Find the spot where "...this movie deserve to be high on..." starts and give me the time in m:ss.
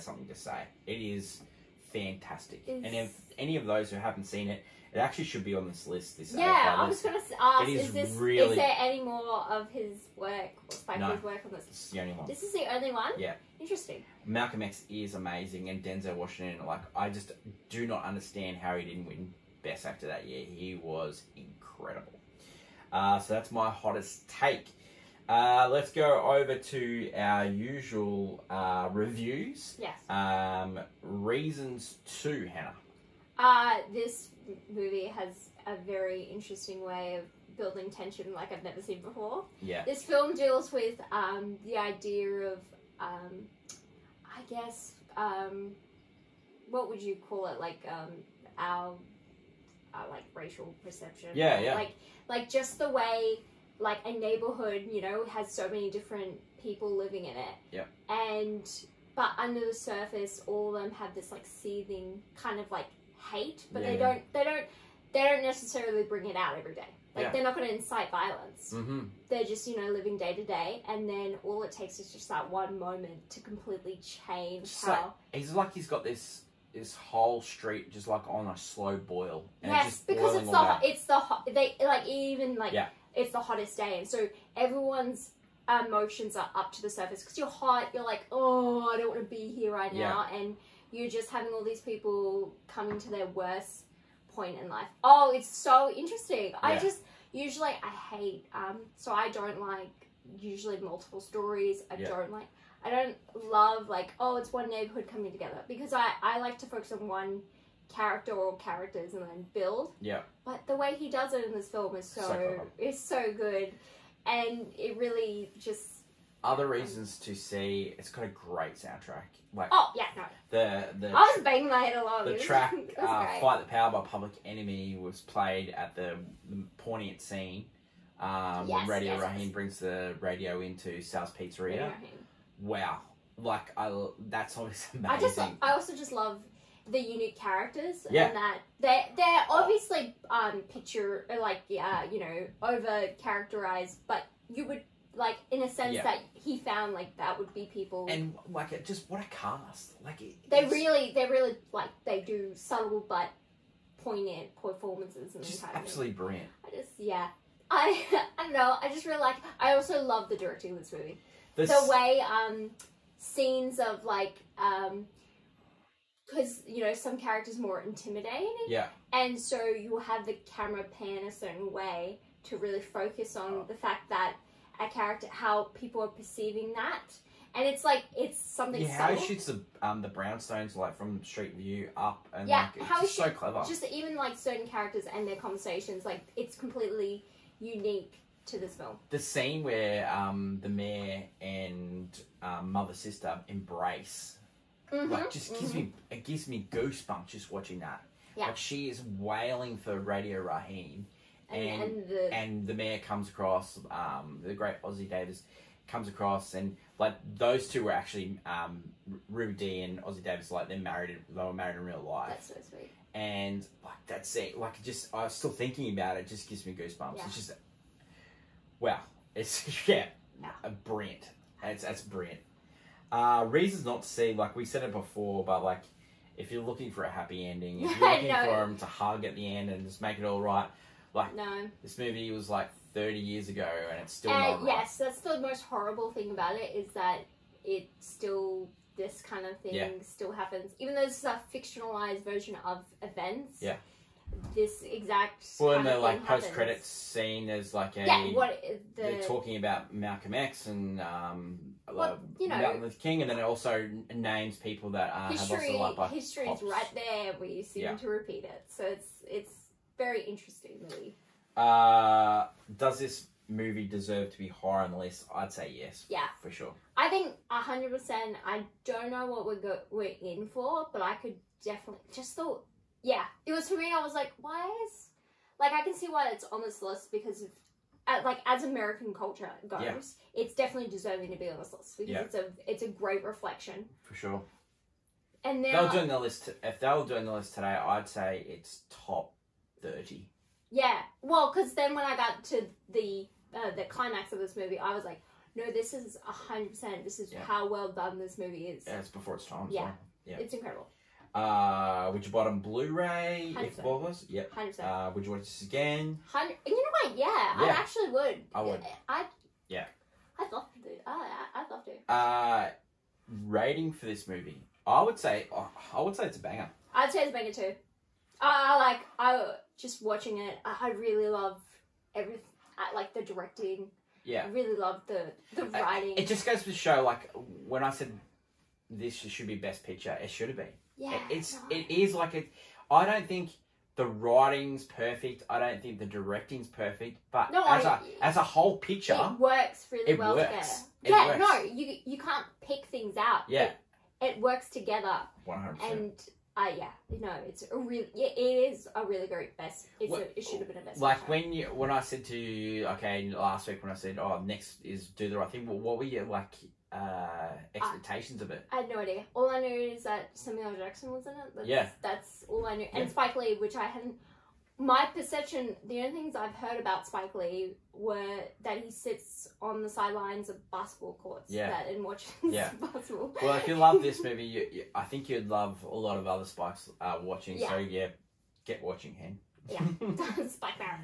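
4:22.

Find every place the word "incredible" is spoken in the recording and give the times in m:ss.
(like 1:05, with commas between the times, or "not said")
0:21, 5:00.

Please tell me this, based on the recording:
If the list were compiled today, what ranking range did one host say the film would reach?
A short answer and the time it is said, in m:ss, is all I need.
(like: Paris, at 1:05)
Top 30, at 4:48.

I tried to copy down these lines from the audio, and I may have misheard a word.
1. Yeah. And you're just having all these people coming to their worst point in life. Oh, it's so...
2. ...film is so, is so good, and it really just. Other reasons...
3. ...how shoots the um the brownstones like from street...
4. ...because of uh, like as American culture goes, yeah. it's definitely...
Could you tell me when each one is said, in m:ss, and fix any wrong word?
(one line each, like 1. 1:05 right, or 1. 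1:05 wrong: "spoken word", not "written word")
1. 1:30 right
2. 1:51 right
3. 2:59 right
4. 4:37 right.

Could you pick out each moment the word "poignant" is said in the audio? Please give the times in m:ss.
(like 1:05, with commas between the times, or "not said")
2:06, 2:34.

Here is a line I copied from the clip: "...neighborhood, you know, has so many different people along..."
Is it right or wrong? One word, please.
wrong.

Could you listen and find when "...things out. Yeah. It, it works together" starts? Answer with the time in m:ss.
5:42.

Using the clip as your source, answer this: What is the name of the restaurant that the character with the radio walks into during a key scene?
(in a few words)
Sal's Pizzeria.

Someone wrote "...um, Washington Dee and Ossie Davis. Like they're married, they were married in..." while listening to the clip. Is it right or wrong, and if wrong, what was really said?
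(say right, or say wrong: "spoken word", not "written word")
wrong: "Ruby", not "Washington".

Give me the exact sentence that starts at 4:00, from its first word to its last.
still happens, even though this is a fictionalized version of events.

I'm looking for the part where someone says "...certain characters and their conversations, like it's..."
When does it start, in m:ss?
3:04.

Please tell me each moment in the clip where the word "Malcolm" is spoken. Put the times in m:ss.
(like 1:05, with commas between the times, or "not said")
0:14, 4:09.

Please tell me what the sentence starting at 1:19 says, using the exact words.
yes, because it's the, it's the it's the they like even like yeah it's the hottest day.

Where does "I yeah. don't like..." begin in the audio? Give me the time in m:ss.
1:41.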